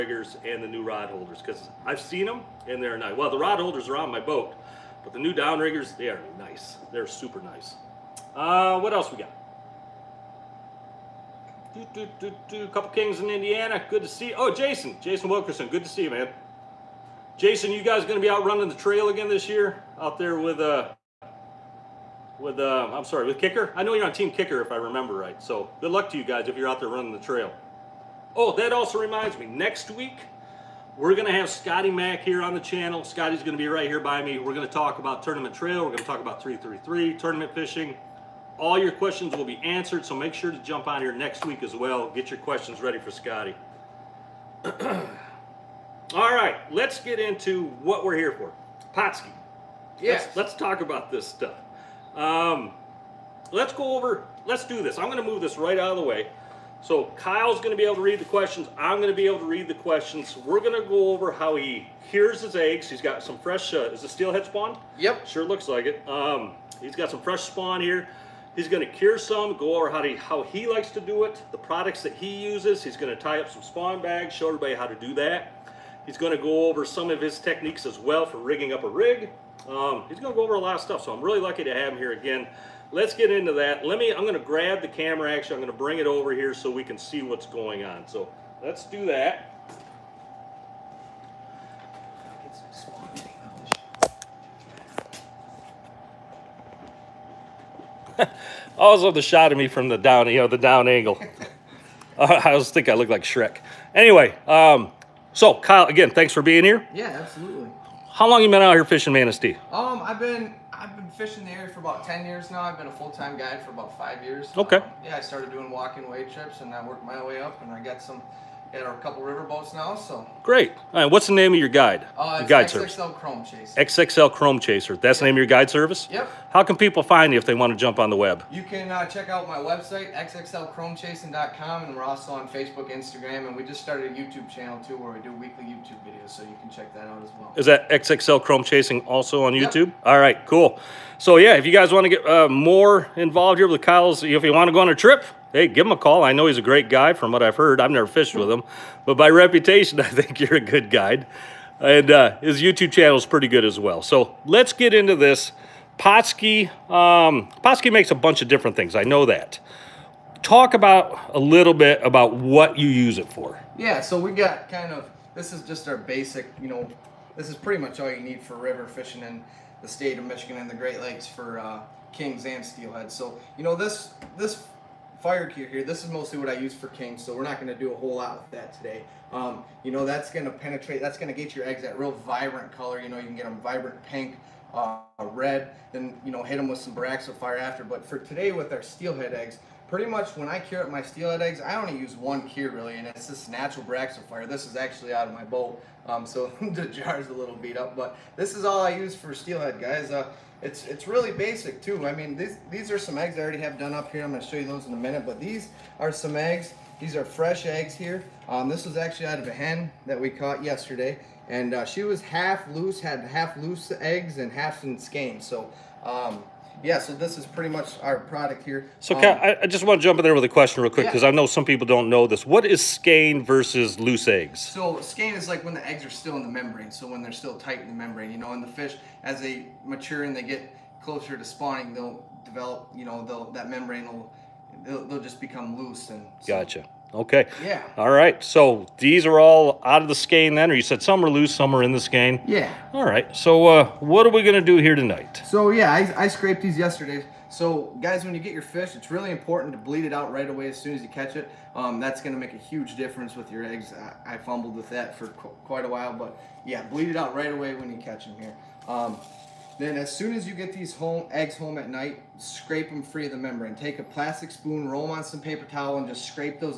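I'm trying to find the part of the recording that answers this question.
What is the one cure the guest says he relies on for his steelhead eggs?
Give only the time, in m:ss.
3:13.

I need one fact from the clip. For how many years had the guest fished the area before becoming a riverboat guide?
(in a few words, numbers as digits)
10 years.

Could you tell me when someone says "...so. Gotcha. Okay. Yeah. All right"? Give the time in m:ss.
3:56.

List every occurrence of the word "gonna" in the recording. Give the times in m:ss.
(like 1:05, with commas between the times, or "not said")
3:24.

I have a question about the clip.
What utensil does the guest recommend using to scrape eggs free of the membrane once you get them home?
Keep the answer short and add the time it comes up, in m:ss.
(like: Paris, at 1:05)
Plastic spoon, at 4:24.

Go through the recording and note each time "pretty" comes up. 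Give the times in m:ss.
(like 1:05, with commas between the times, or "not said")
2:33, 2:47, 3:09, 3:37.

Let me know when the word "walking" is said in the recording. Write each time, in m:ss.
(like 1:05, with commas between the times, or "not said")
1:55.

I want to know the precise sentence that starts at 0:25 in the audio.
So good luck to you guys if you're out there running the trail.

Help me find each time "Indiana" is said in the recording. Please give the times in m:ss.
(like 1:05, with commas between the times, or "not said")
0:13.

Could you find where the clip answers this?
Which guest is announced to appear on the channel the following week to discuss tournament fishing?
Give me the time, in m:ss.
0:31.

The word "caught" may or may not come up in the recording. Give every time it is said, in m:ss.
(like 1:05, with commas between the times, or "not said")
3:30.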